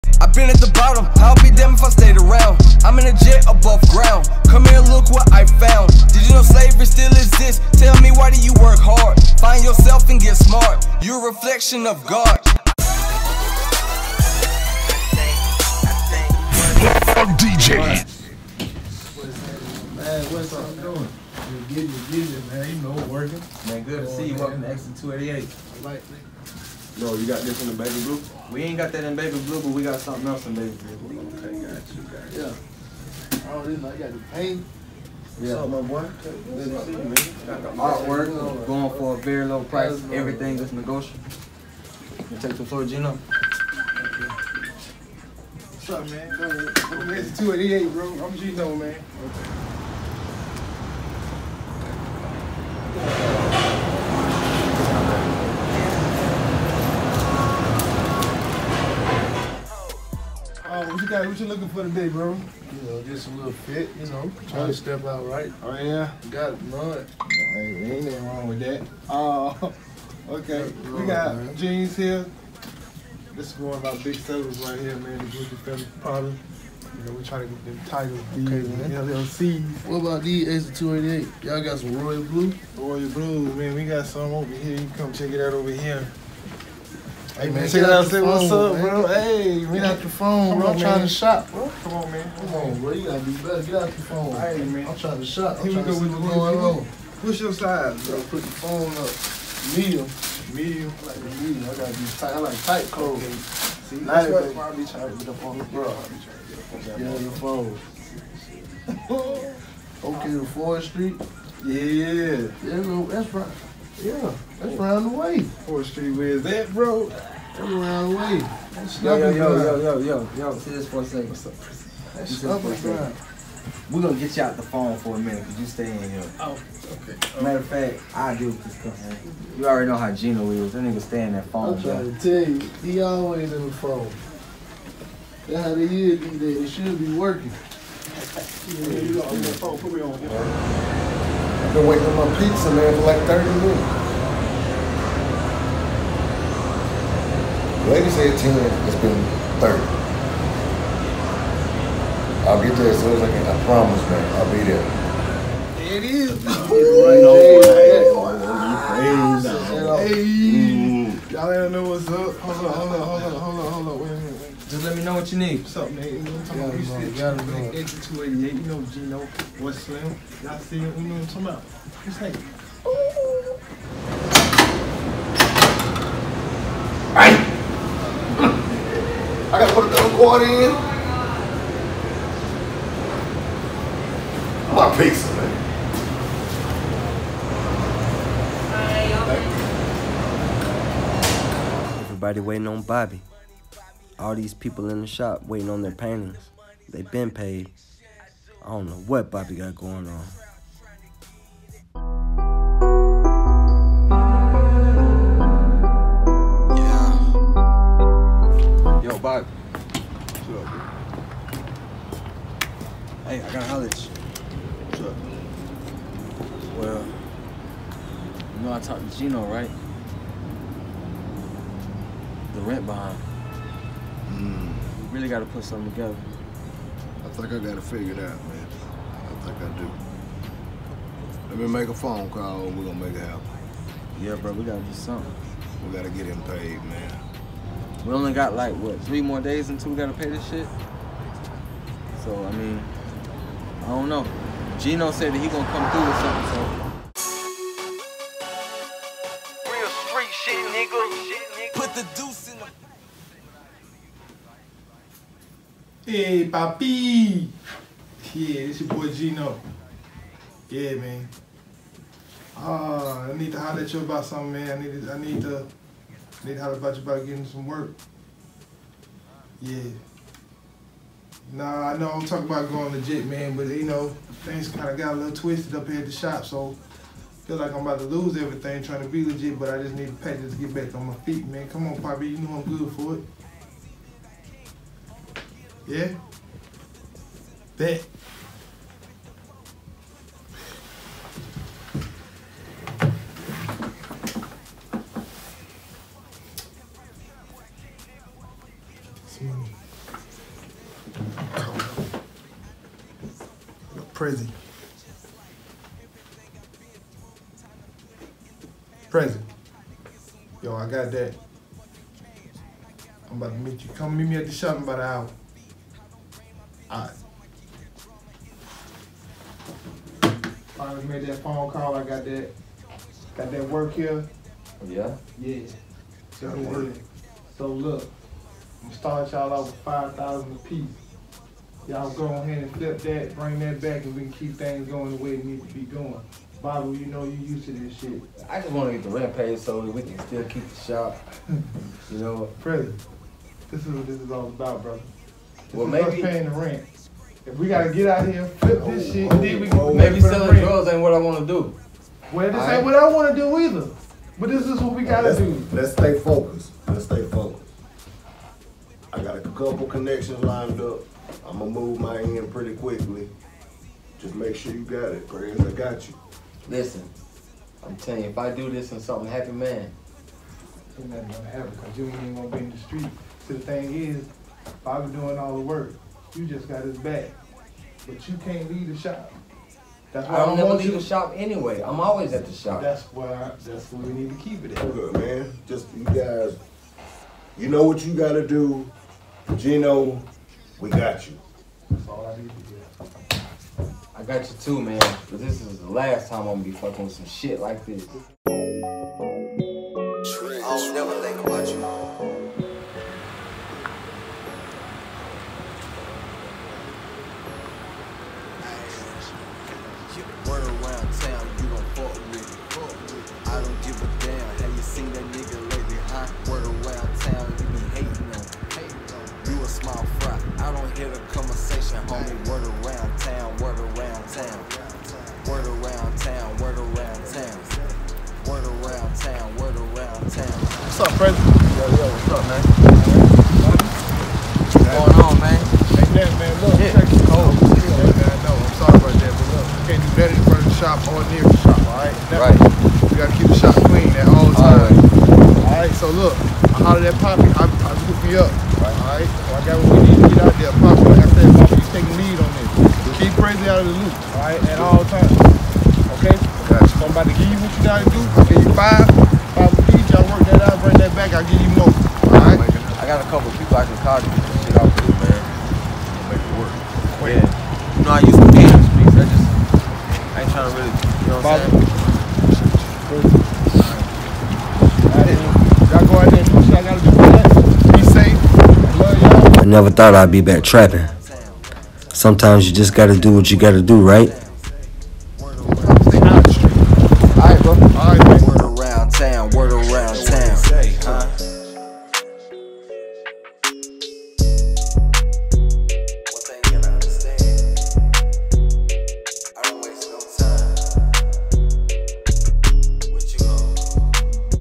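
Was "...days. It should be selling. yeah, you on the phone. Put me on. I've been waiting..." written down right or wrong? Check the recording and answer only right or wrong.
wrong.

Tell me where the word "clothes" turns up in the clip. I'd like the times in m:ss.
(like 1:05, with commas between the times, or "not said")
1:42.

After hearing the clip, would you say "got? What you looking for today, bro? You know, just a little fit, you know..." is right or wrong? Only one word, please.
right.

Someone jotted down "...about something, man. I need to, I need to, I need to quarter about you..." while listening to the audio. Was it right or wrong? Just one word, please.
wrong.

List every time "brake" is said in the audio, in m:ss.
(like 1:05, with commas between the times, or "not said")
not said.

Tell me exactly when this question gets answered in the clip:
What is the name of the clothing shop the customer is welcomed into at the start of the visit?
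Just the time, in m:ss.
0:24.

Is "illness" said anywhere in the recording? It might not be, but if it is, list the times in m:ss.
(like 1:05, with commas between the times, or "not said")
not said.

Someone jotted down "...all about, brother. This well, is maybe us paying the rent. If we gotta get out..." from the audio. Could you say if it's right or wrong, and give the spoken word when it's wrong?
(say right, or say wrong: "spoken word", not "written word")
right.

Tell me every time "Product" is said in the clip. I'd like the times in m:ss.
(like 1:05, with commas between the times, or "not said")
1:15.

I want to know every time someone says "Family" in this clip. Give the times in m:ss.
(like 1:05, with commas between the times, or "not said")
1:15.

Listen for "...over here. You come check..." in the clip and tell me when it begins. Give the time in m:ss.
1:24.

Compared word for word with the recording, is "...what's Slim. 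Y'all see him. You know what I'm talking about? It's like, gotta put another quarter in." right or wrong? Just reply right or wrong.
right.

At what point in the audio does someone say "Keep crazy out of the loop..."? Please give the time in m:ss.
7:33.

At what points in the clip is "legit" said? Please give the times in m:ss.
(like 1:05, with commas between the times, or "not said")
4:32, 4:39.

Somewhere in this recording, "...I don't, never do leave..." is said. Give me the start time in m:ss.
6:20.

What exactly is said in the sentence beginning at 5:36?
Bible, you know you used to this shit.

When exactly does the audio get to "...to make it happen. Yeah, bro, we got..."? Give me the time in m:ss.
3:52.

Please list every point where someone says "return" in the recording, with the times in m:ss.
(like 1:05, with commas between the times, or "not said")
not said.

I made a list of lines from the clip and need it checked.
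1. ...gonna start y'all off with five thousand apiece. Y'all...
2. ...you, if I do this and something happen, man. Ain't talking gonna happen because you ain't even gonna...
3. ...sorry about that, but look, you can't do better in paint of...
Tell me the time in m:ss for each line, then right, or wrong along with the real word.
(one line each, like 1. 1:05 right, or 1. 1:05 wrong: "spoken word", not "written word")
1. 5:28 right
2. 6:08 wrong: "nothing", not "talking"
3. 7:18 wrong: "front", not "paint".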